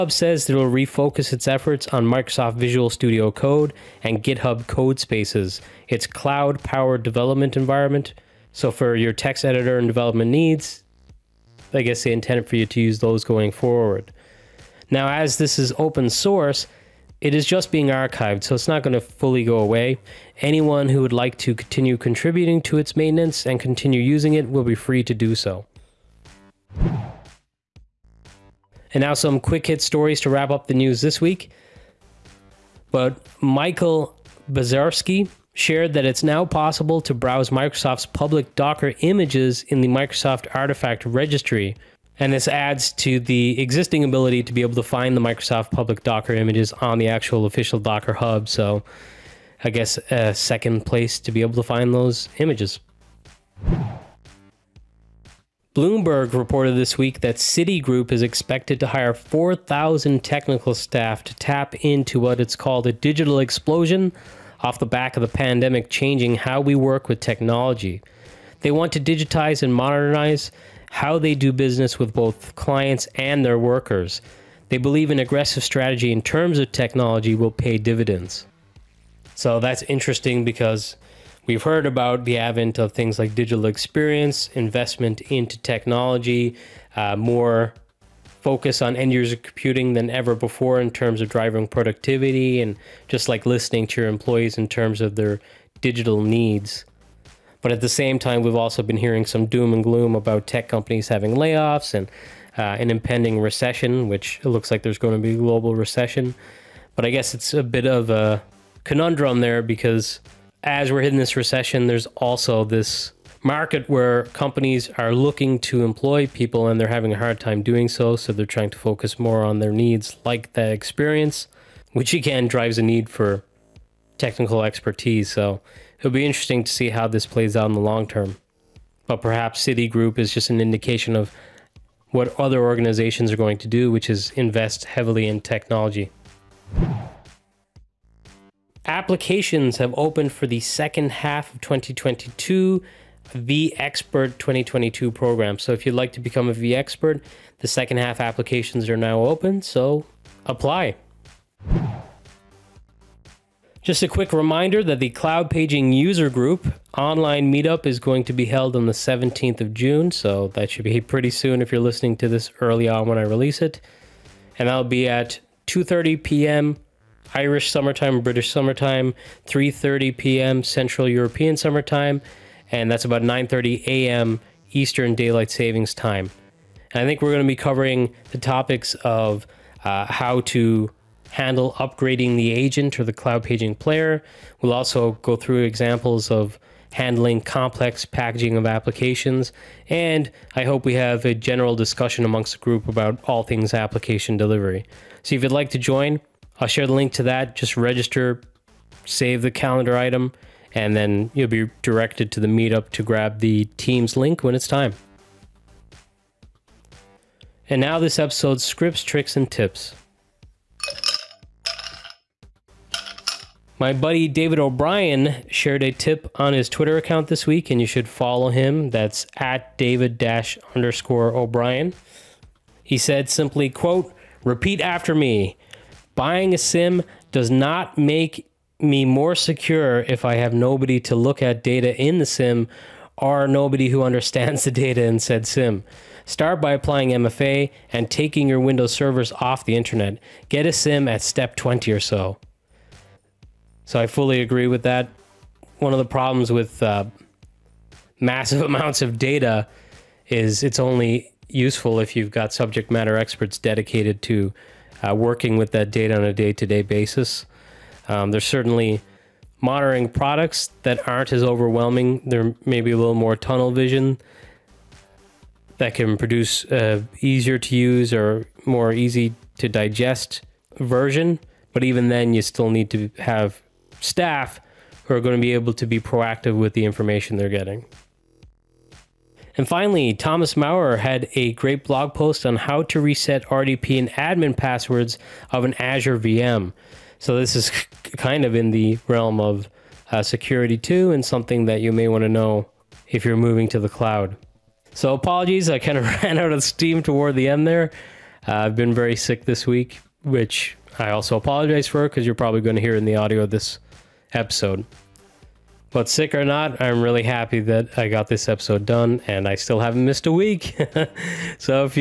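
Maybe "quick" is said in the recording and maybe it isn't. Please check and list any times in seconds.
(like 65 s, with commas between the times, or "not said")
29 s, 154 s.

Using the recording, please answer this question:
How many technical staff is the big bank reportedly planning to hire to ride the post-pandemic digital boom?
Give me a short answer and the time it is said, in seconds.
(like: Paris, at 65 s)
4,000, at 59 s.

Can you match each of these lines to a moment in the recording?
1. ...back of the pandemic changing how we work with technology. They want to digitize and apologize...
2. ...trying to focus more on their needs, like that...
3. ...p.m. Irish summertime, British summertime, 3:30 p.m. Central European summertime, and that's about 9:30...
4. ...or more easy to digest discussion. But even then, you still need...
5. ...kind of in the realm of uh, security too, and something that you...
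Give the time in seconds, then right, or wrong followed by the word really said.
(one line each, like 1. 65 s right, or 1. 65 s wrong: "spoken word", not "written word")
1. 64 s wrong: "modernize", not "apologize"
2. 118 s right
3. 166 s right
4. 268 s wrong: "version", not "discussion"
5. 288 s right.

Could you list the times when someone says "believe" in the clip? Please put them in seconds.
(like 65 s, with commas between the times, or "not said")
74 s.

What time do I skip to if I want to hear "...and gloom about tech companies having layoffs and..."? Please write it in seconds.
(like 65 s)
99 s.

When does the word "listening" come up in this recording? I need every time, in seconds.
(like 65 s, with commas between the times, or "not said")
93 s, 161 s.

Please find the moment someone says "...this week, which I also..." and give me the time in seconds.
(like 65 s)
299 s.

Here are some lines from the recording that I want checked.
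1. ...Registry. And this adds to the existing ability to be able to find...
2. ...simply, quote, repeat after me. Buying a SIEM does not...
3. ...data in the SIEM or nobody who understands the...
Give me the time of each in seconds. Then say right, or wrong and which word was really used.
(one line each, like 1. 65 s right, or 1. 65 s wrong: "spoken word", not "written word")
1. 41 s right
2. 223 s right
3. 231 s right.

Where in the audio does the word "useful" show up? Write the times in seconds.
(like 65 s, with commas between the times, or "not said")
251 s.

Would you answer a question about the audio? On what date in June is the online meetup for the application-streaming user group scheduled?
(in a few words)
17th of June.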